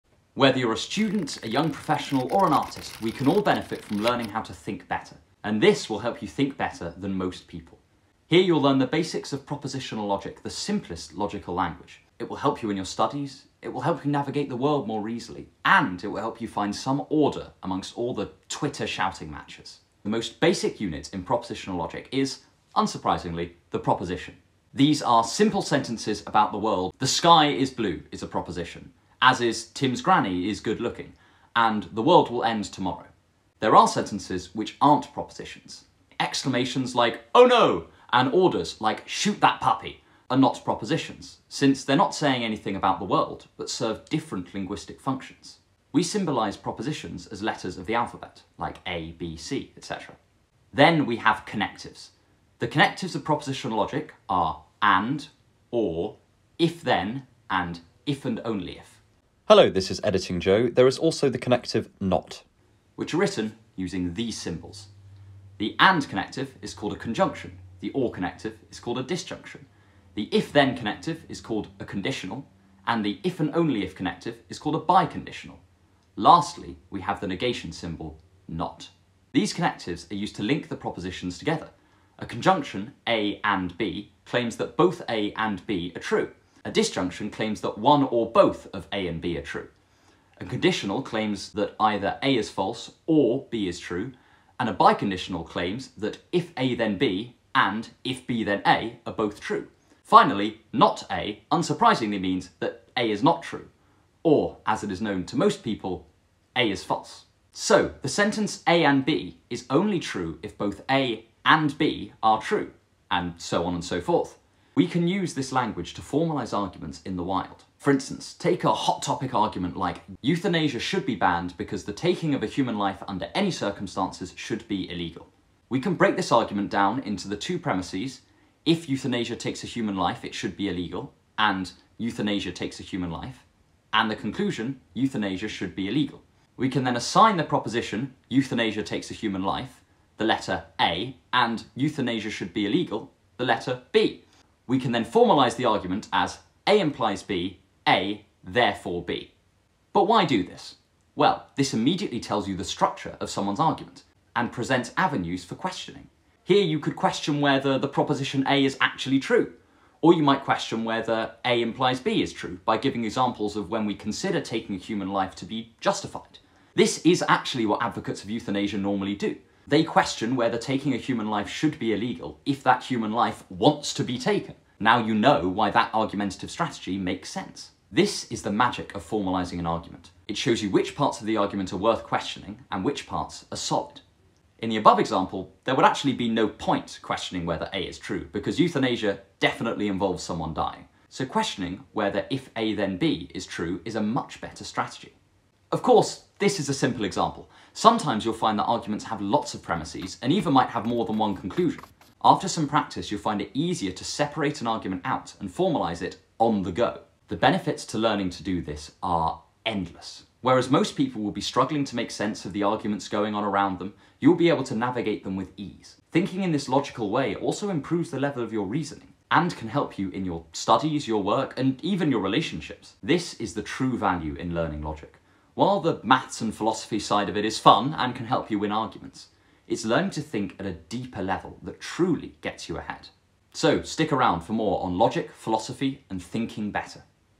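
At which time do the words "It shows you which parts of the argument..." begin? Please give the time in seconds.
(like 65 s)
180 s.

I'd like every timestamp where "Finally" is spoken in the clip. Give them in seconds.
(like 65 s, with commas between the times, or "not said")
100 s.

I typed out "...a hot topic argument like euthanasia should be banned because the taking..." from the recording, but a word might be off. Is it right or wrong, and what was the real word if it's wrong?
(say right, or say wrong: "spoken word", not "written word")
right.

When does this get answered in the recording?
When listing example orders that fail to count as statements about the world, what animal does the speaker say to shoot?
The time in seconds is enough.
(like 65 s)
39 s.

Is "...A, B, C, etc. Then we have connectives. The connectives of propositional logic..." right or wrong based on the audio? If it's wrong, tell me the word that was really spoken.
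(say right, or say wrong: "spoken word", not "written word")
right.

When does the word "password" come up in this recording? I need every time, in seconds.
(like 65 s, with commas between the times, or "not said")
not said.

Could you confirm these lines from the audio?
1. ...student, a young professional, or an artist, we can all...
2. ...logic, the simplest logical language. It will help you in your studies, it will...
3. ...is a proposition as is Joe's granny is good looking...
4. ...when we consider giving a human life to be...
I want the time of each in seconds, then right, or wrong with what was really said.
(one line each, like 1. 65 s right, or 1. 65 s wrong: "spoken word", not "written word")
1. 0 s right
2. 10 s right
3. 28 s wrong: "Tim", not "Joe"
4. 163 s wrong: "taking", not "giving".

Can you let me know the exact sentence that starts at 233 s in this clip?
So stick around for more on logic, philosophy, and thinking better.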